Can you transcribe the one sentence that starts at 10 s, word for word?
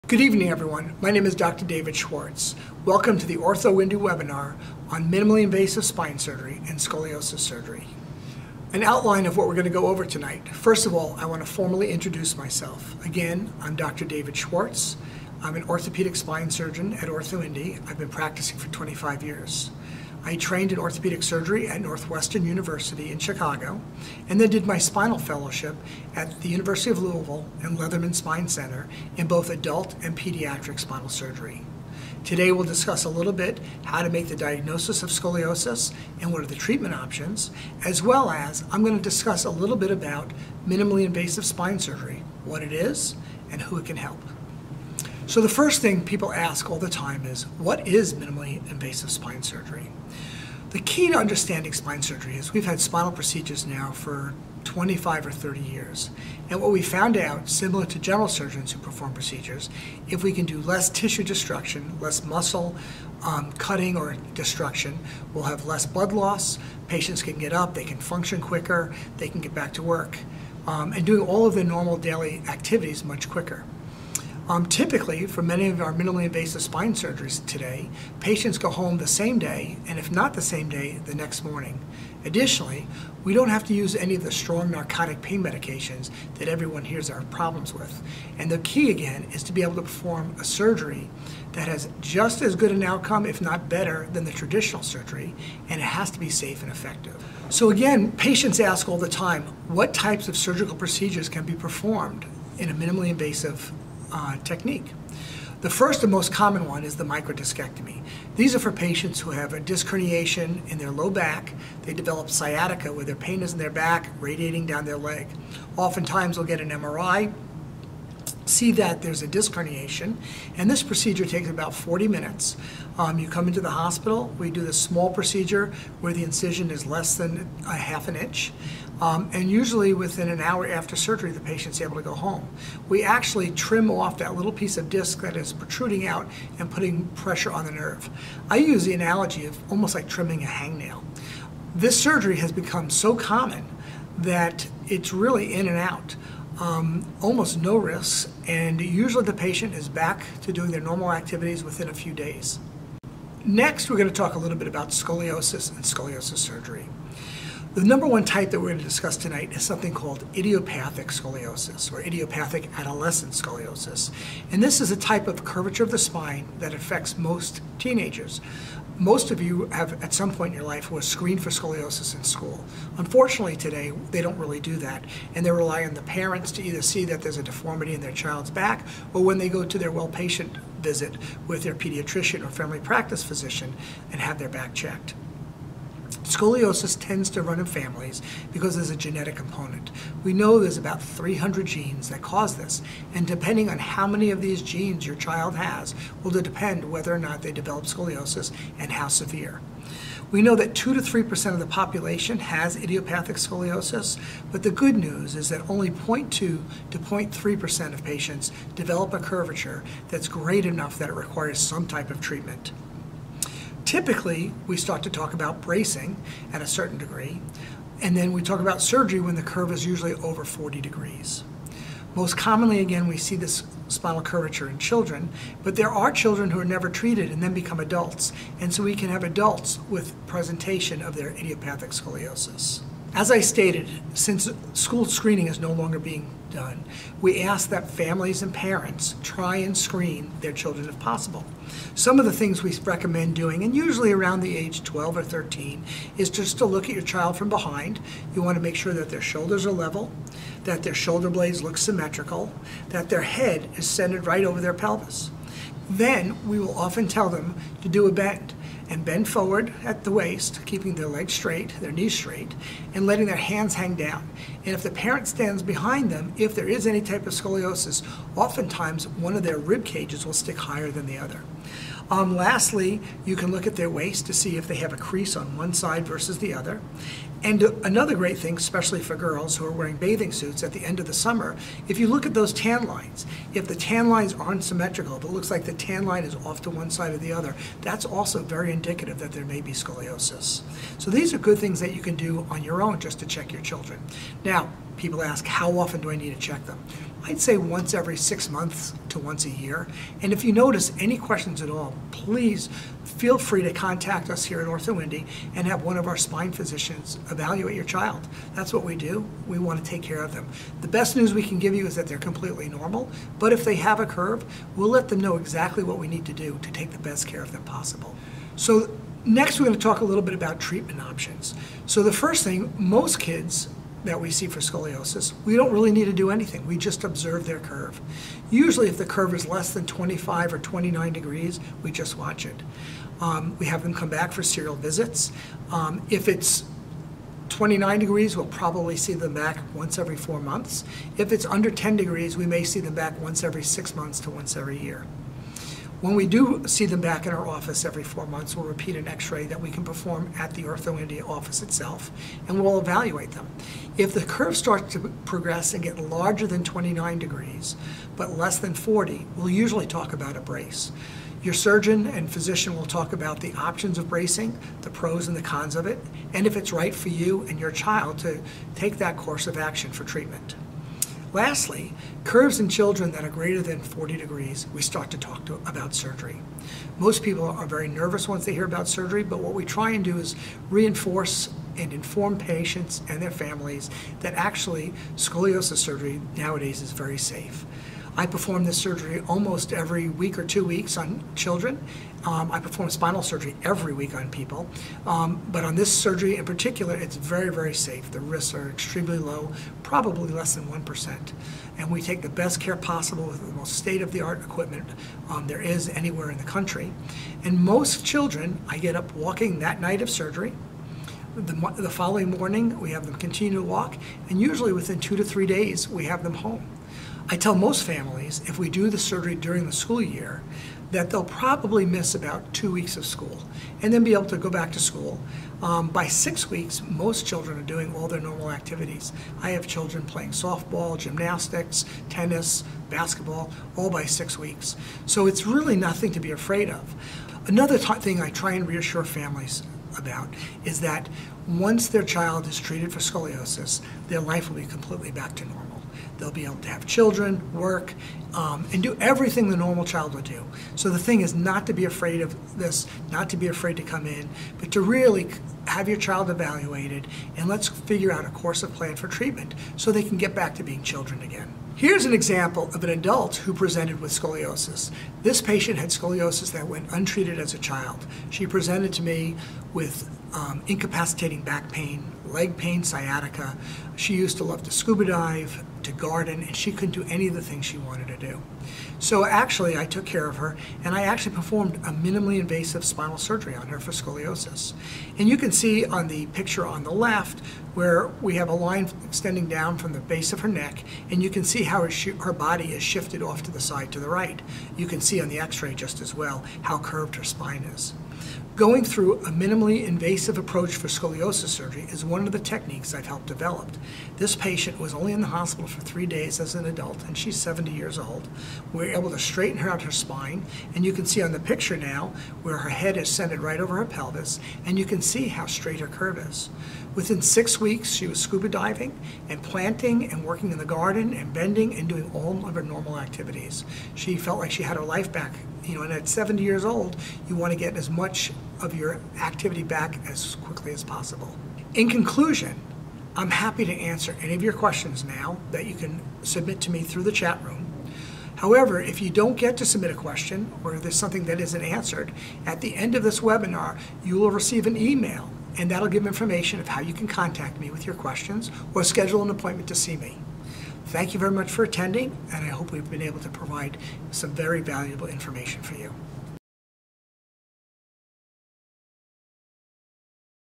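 First of all, I want to formally introduce myself.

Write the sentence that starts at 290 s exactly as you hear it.
So these are good things that you can do on your own just to check your children.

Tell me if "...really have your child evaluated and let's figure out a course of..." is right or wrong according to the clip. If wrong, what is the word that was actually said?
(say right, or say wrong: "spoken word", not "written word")
right.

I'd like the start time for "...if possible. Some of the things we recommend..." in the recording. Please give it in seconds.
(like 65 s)
240 s.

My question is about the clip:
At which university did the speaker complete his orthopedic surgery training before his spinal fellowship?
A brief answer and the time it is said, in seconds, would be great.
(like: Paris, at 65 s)
Northwestern University, at 21 s.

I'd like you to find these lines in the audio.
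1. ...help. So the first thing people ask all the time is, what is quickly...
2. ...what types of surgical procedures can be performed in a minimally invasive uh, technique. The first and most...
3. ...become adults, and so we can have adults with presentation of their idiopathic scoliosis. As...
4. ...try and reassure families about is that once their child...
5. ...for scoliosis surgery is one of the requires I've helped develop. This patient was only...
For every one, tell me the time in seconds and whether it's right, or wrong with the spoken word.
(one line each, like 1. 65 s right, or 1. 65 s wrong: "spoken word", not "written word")
1. 43 s wrong: "minimally", not "quickly"
2. 99 s right
3. 227 s right
4. 438 s right
5. 500 s wrong: "techniques", not "requires".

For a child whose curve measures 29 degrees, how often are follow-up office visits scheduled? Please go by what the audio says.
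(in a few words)
once every four months.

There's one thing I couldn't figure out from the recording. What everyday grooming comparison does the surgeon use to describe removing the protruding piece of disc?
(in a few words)
trimming a hangnail.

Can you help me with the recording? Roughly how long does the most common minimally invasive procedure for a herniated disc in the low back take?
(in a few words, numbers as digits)
40 minutes.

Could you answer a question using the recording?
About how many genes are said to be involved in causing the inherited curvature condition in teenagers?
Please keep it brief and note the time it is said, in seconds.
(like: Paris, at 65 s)
300, at 191 s.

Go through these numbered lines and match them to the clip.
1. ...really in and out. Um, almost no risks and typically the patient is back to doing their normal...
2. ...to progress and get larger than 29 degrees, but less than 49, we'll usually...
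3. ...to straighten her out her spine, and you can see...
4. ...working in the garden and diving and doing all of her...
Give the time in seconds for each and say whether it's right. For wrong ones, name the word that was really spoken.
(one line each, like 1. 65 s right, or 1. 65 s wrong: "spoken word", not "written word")
1. 145 s wrong: "usually", not "typically"
2. 354 s wrong: "40", not "49"
3. 509 s right
4. 520 s wrong: "bending", not "diving".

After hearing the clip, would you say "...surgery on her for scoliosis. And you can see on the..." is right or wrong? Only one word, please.
right.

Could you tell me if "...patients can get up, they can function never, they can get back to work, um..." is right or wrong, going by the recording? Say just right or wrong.
wrong.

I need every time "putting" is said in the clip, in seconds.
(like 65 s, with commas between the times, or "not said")
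136 s.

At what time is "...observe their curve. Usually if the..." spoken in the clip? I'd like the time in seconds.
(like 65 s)
327 s.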